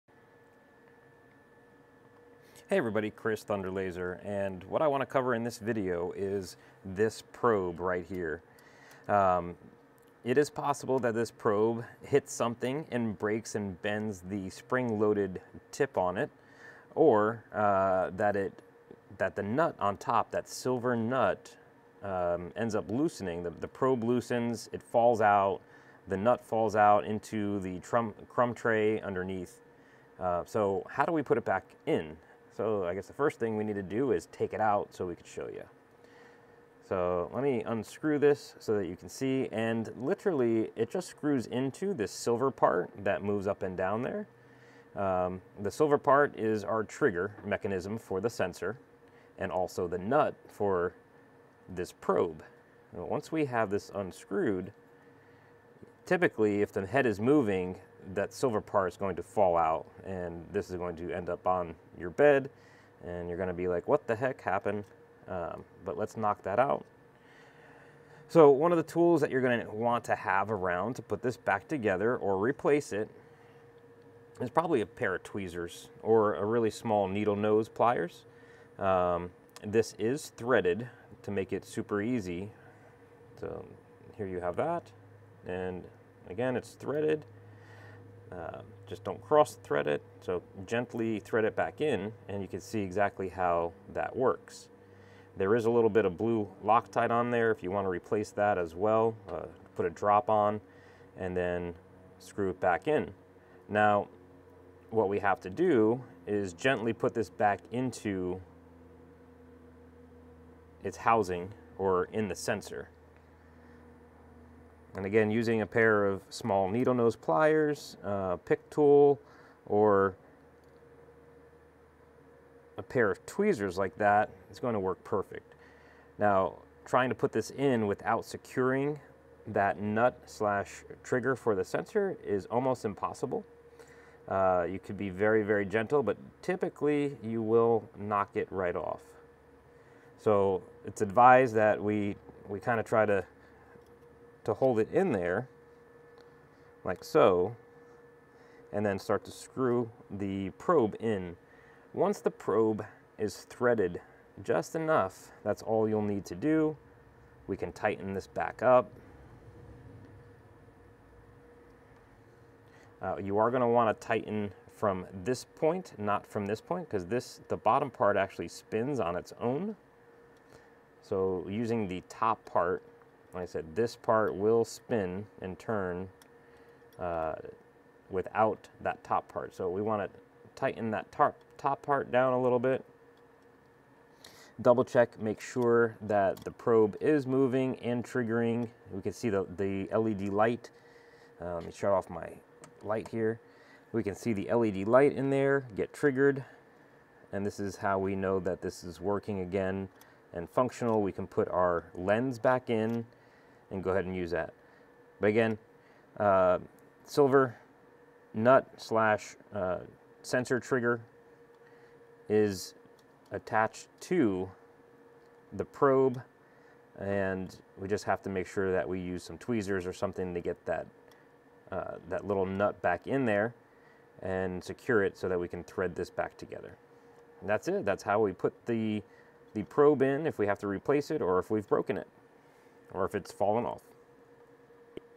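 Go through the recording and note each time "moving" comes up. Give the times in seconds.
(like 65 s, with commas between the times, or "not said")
57 s, 187 s.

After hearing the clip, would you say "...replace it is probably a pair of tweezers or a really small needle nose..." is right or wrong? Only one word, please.
right.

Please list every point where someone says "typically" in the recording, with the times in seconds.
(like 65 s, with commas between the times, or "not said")
56 s, 136 s.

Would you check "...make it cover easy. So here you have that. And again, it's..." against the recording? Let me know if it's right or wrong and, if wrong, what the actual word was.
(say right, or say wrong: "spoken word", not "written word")
wrong: "super", not "cover".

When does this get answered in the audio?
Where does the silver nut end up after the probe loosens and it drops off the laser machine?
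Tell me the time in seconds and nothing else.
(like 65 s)
27 s.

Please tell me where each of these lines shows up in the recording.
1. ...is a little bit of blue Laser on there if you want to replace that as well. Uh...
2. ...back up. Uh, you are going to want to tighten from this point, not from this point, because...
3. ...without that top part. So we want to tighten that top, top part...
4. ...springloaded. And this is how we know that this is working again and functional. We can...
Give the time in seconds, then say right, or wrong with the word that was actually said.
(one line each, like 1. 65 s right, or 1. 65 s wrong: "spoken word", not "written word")
1. 95 s wrong: "Loctite", not "Laser"
2. 158 s right
3. 178 s right
4. 195 s wrong: "triggered", not "springloaded".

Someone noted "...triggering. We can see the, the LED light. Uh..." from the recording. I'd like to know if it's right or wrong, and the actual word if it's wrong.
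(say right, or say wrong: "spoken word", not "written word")
right.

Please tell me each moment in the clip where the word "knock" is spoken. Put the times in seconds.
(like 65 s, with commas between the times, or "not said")
66 s, 137 s.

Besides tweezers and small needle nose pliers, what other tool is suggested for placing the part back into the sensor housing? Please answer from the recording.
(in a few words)
pick tool.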